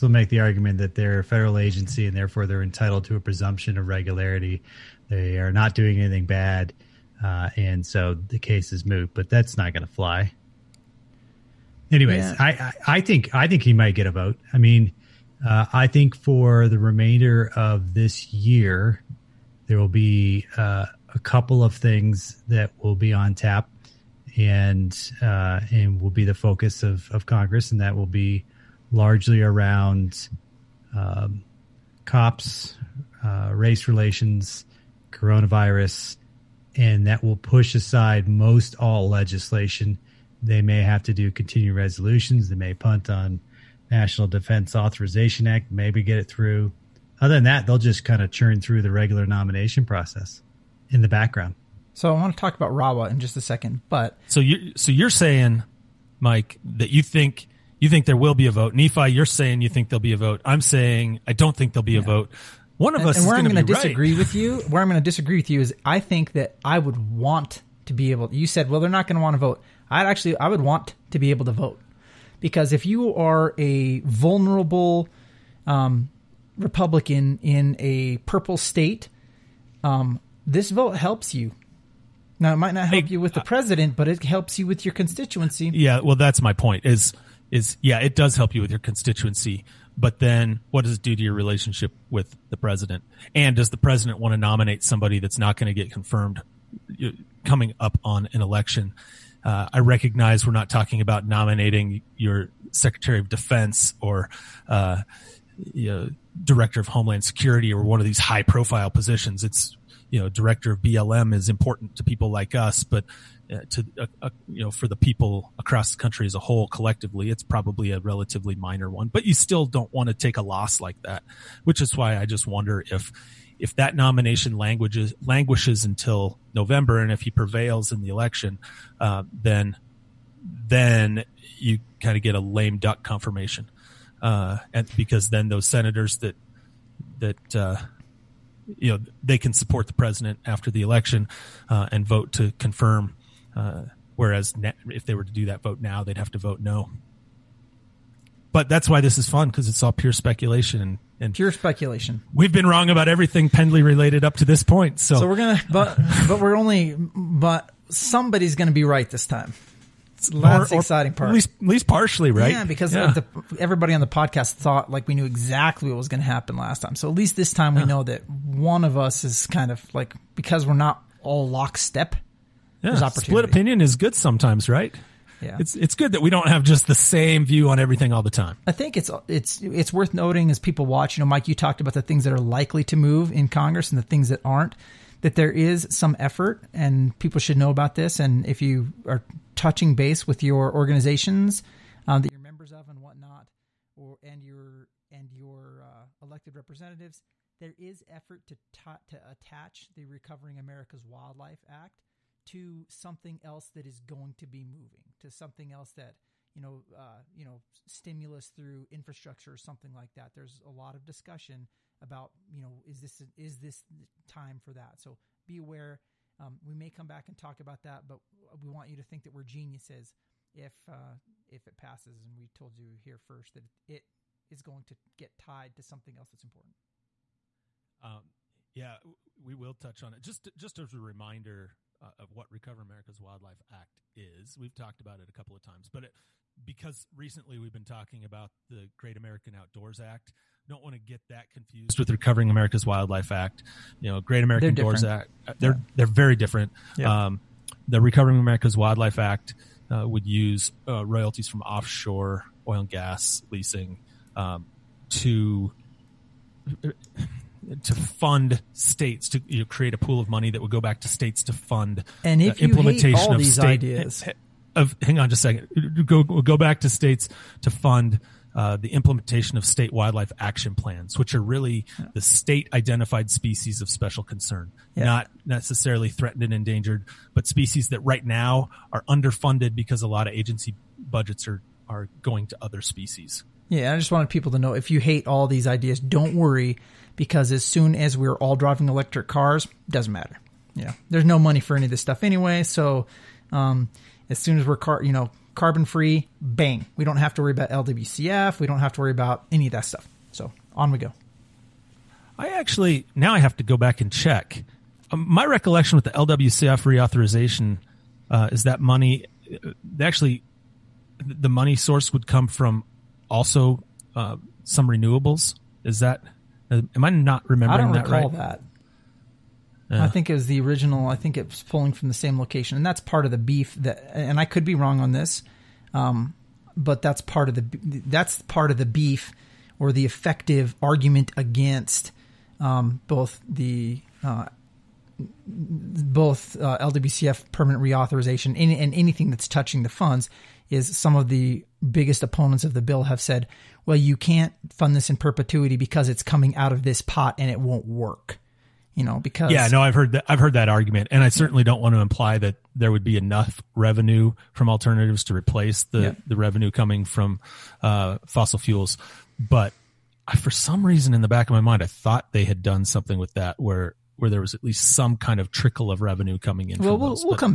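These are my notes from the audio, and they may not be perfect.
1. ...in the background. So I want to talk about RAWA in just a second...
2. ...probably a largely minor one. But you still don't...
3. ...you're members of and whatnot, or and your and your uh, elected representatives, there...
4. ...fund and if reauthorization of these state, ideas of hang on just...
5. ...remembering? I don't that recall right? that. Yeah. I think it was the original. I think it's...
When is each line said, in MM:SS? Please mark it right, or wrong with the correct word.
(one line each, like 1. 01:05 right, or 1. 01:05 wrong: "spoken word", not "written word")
1. 00:50 right
2. 01:57 wrong: "relatively", not "largely"
3. 03:12 right
4. 04:21 wrong: "implementation", not "reauthorization"
5. 05:17 right.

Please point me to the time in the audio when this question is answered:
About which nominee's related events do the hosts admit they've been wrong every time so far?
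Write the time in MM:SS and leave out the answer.
02:33.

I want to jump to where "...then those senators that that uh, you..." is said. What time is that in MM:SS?
02:15.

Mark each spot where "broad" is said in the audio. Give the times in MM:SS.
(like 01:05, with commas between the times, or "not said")
not said.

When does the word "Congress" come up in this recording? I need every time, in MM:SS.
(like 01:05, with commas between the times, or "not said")
00:27, 03:03.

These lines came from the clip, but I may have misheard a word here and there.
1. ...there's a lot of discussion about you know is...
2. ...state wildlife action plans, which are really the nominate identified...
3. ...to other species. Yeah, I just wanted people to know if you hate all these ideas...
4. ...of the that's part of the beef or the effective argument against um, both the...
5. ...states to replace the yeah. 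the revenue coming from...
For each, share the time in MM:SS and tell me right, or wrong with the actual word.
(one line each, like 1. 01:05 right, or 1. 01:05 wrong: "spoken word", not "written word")
1. 03:30 right
2. 04:29 wrong: "state", not "nominate"
3. 04:42 right
4. 05:27 right
5. 05:54 wrong: "alternatives", not "states".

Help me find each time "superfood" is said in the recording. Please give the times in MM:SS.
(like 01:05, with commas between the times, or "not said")
not said.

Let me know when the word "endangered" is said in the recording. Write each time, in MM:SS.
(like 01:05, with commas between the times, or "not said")
04:36.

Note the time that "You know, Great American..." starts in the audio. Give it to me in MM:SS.
04:04.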